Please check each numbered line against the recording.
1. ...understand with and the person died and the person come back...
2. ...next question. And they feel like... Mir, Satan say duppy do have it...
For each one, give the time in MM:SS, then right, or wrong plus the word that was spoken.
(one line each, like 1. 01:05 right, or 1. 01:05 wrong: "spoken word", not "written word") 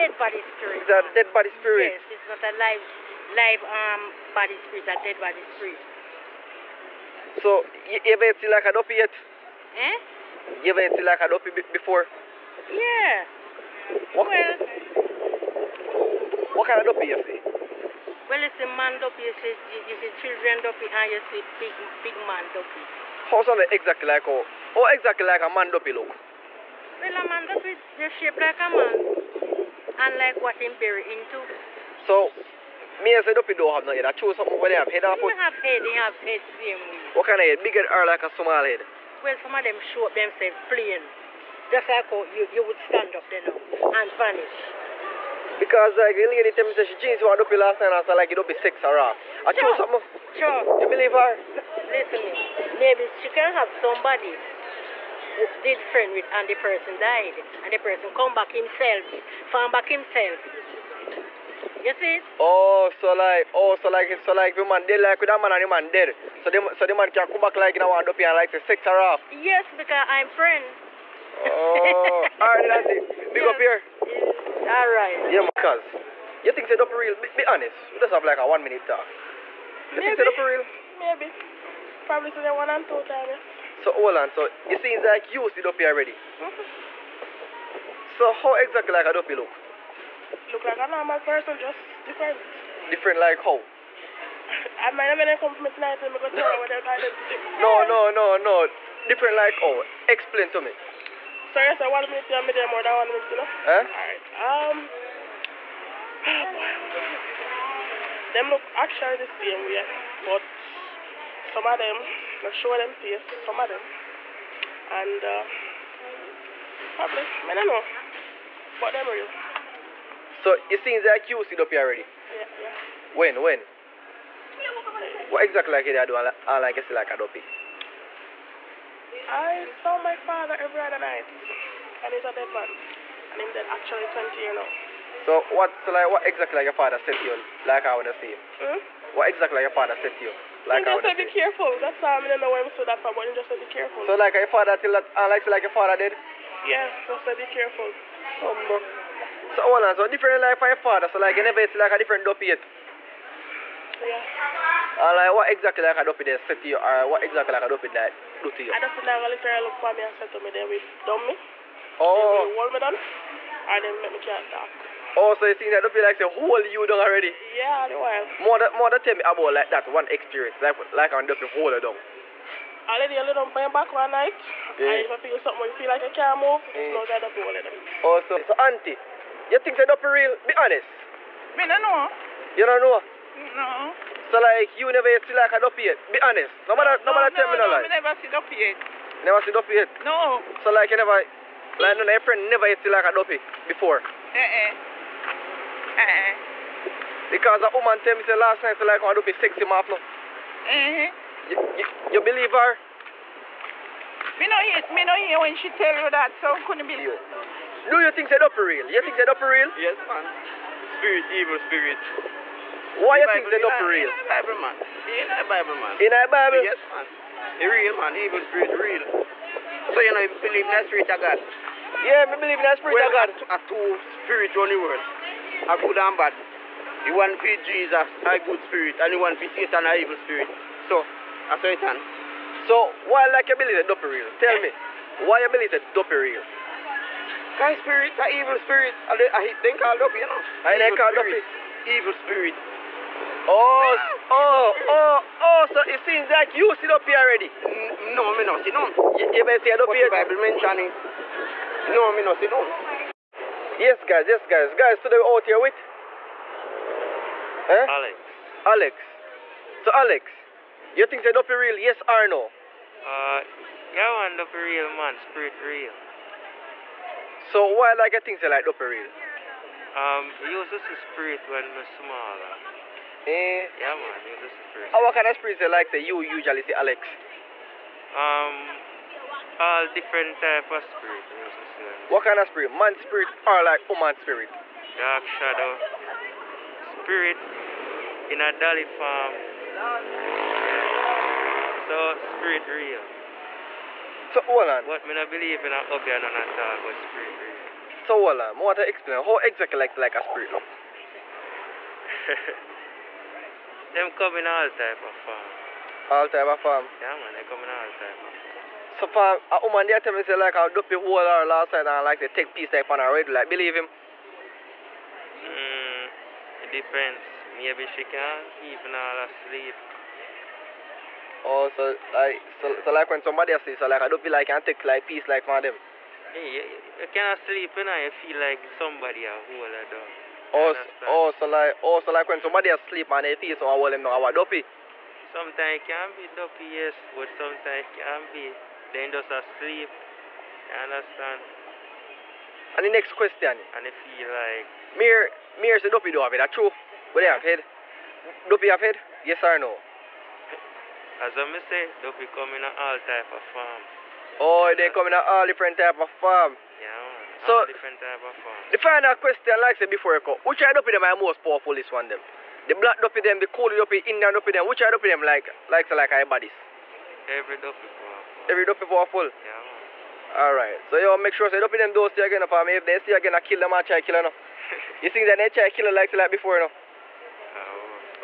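1. 00:55 wrong: "friend", not "understand"
2. 05:42 wrong: "Mir", not "Satan".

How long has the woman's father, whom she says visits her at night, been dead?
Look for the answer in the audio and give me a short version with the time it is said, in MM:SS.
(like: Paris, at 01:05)
20 years, at 02:14.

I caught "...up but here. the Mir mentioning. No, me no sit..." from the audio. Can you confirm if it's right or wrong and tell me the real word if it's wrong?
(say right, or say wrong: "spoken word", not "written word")
wrong: "Bible", not "Mir".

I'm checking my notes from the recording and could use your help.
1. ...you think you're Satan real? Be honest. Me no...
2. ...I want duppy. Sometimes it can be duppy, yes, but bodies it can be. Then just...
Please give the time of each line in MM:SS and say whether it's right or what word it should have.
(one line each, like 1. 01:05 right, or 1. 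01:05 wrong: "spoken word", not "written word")
1. 02:59 wrong: "Duppy", not "Satan"
2. 05:34 wrong: "sometimes", not "bodies".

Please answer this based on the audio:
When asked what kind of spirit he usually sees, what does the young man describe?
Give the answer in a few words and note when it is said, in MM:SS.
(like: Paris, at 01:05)
Dark shadow, at 04:44.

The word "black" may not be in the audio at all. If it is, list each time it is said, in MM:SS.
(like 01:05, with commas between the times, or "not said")
06:02.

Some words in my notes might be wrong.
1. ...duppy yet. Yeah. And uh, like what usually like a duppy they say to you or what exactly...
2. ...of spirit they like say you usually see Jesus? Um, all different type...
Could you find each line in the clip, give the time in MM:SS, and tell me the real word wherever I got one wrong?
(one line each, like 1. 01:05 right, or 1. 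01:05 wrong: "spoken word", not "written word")
1. 02:32 wrong: "exactly", not "usually"
2. 04:35 wrong: "Alex", not "Jesus".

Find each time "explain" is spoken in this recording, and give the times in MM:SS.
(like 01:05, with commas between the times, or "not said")
01:40, 04:58.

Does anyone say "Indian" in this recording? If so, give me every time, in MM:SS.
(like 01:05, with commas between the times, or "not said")
06:03.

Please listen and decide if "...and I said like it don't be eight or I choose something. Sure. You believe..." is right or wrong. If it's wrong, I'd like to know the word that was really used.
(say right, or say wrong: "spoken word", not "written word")
wrong: "six", not "eight".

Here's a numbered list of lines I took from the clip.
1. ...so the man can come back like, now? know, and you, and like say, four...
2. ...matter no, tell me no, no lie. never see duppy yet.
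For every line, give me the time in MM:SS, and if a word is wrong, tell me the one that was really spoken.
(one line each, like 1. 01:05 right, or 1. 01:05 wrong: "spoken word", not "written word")
1. 01:06 wrong: "six", not "four"
2. 03:07 right.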